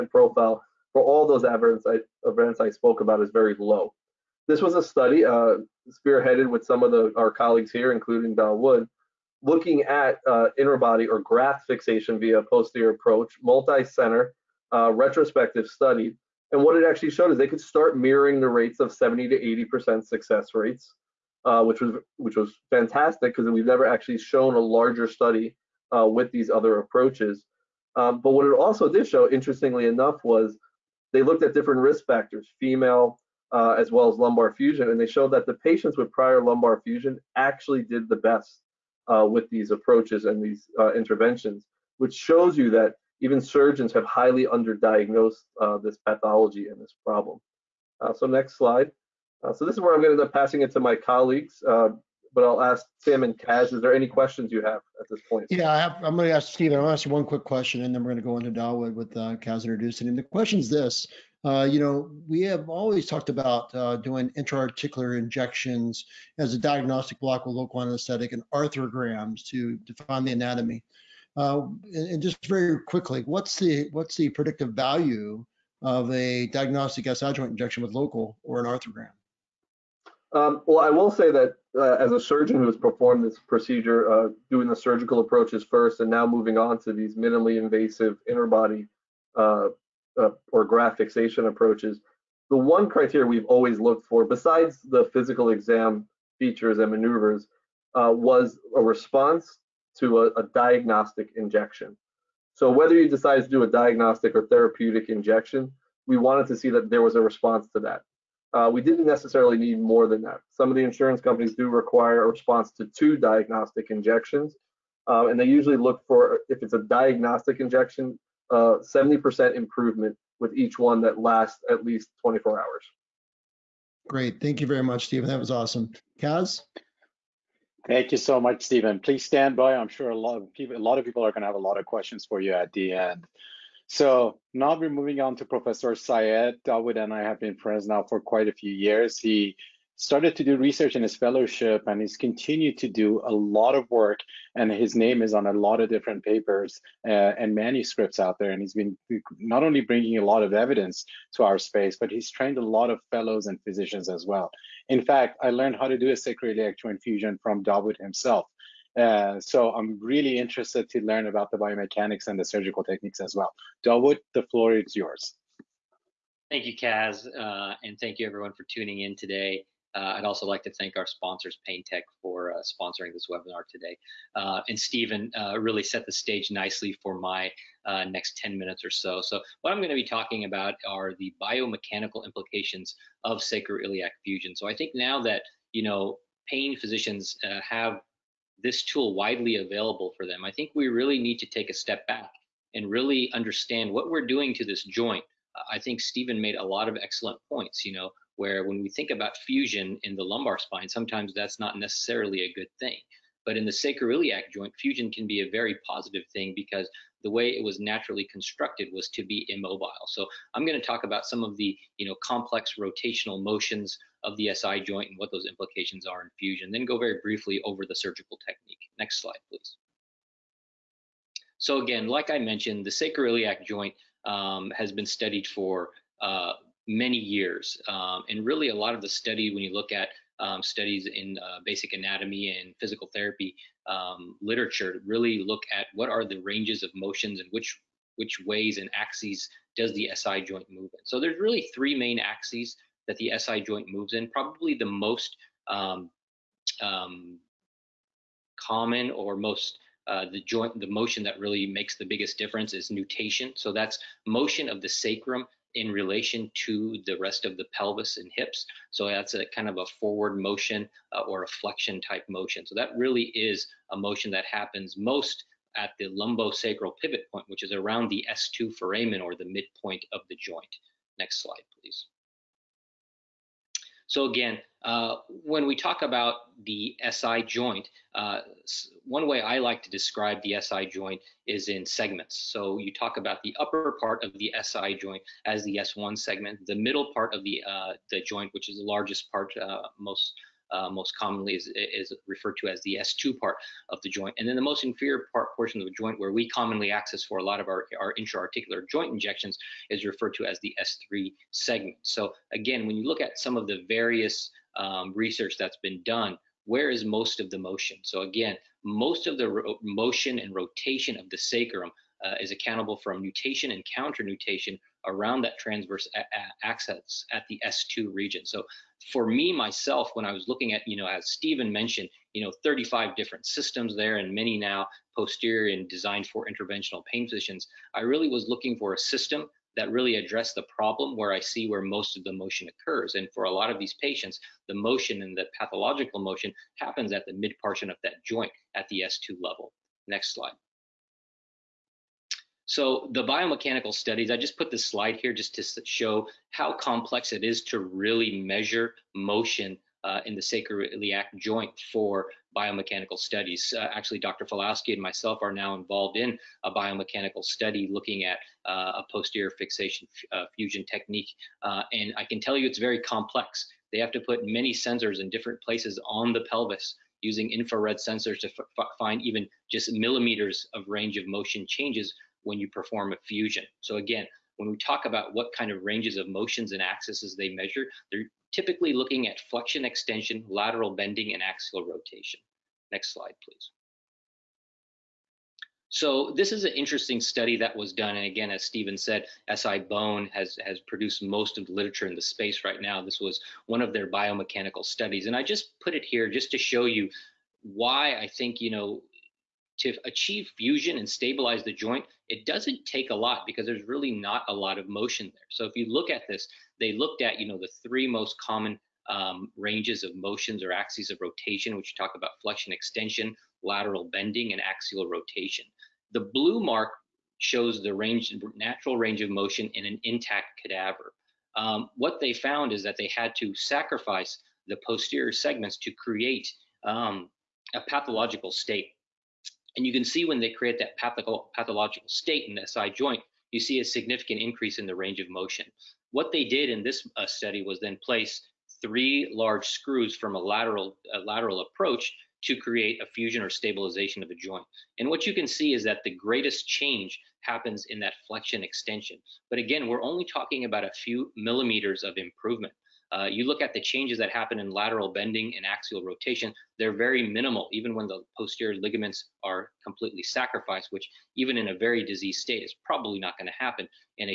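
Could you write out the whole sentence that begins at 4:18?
So that's a kind of a forward motion uh, or a flexion type motion.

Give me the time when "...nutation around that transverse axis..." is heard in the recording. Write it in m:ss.
5:14.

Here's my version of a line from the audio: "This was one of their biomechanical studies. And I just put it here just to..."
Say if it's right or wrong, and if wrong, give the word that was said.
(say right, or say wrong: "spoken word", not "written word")
right.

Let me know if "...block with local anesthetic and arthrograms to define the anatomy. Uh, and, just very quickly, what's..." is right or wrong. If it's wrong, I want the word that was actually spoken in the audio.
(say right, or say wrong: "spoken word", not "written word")
right.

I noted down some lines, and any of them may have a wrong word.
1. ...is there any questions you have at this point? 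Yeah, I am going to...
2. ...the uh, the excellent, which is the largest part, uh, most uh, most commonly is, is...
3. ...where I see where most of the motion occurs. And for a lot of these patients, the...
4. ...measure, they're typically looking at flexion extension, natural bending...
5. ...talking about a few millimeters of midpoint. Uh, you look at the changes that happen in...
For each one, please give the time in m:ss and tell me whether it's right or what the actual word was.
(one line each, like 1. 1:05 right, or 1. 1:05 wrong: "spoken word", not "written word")
1. 0:53 right
2. 4:47 wrong: "joint", not "excellent"
3. 5:31 right
4. 6:17 wrong: "lateral", not "natural"
5. 7:30 wrong: "improvement", not "midpoint".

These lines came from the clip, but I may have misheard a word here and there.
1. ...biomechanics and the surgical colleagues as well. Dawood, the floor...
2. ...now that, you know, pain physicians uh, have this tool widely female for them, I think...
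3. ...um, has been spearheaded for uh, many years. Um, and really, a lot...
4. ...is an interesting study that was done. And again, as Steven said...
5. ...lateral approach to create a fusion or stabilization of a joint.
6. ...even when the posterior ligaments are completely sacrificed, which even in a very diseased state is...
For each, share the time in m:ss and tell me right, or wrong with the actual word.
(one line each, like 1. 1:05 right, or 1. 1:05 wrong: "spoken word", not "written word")
1. 2:41 wrong: "techniques", not "colleagues"
2. 3:04 wrong: "available", not "female"
3. 3:44 wrong: "studied", not "spearheaded"
4. 6:26 right
5. 7:21 right
6. 7:37 right.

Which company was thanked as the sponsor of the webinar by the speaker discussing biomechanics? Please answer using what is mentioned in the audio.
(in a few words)
PainTEQ.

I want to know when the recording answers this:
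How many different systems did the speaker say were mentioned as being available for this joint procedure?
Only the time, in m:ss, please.
5:22.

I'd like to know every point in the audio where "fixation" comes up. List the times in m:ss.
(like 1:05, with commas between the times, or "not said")
0:11, 1:30, 5:59.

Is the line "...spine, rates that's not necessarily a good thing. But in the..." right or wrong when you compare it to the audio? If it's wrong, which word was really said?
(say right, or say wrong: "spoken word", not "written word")
wrong: "sometimes", not "rates".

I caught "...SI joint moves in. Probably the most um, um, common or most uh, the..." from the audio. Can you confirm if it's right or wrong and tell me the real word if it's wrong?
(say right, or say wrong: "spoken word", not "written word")
right.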